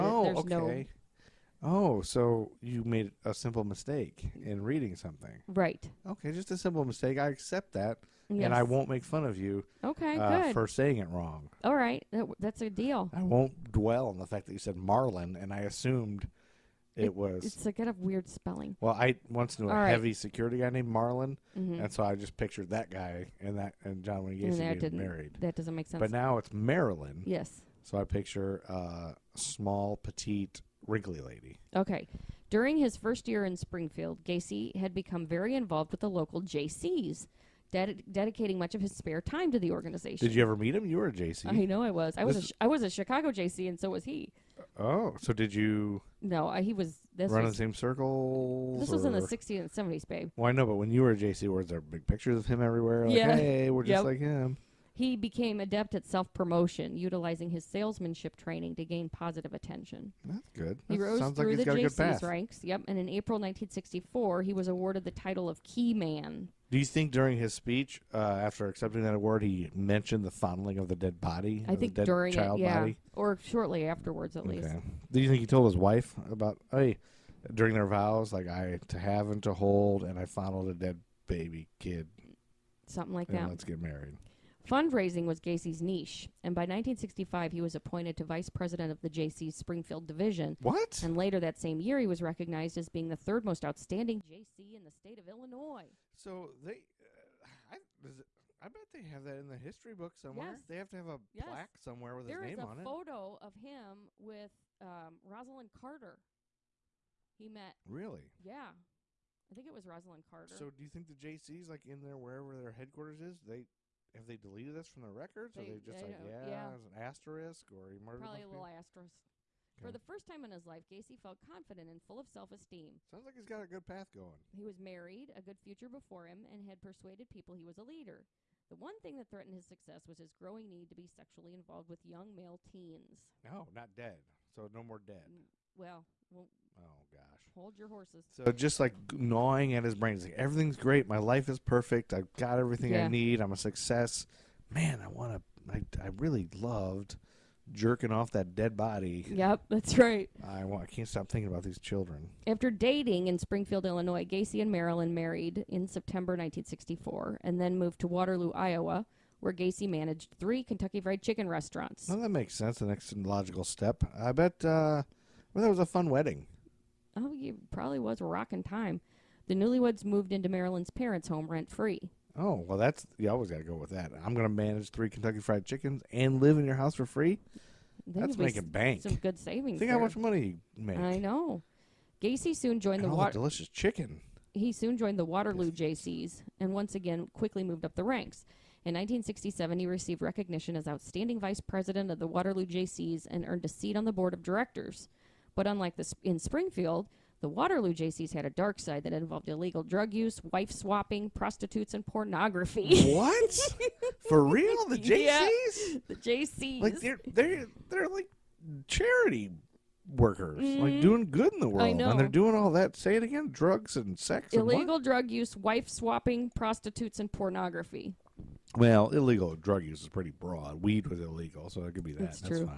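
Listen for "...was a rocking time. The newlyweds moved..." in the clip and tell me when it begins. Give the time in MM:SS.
02:47.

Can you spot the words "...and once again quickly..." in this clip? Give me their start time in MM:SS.
03:06.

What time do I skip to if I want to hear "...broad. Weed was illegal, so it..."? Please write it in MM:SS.
03:40.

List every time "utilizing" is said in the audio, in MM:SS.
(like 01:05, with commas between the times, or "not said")
00:56.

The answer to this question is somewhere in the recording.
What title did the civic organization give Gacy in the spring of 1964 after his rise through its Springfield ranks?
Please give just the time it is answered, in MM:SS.
01:05.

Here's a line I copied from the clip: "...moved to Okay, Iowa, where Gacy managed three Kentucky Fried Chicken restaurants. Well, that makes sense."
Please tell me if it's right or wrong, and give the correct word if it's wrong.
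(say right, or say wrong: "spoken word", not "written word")
wrong: "Waterloo", not "Okay".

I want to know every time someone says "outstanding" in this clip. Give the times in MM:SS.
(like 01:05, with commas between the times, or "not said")
01:33, 03:10.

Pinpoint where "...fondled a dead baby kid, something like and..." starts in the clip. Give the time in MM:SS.
01:20.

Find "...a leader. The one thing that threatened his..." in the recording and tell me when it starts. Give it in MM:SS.
02:07.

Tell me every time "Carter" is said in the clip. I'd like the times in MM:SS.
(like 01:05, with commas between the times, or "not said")
01:45, 01:50.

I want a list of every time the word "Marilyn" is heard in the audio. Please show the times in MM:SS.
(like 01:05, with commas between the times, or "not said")
00:26, 02:34, 02:50.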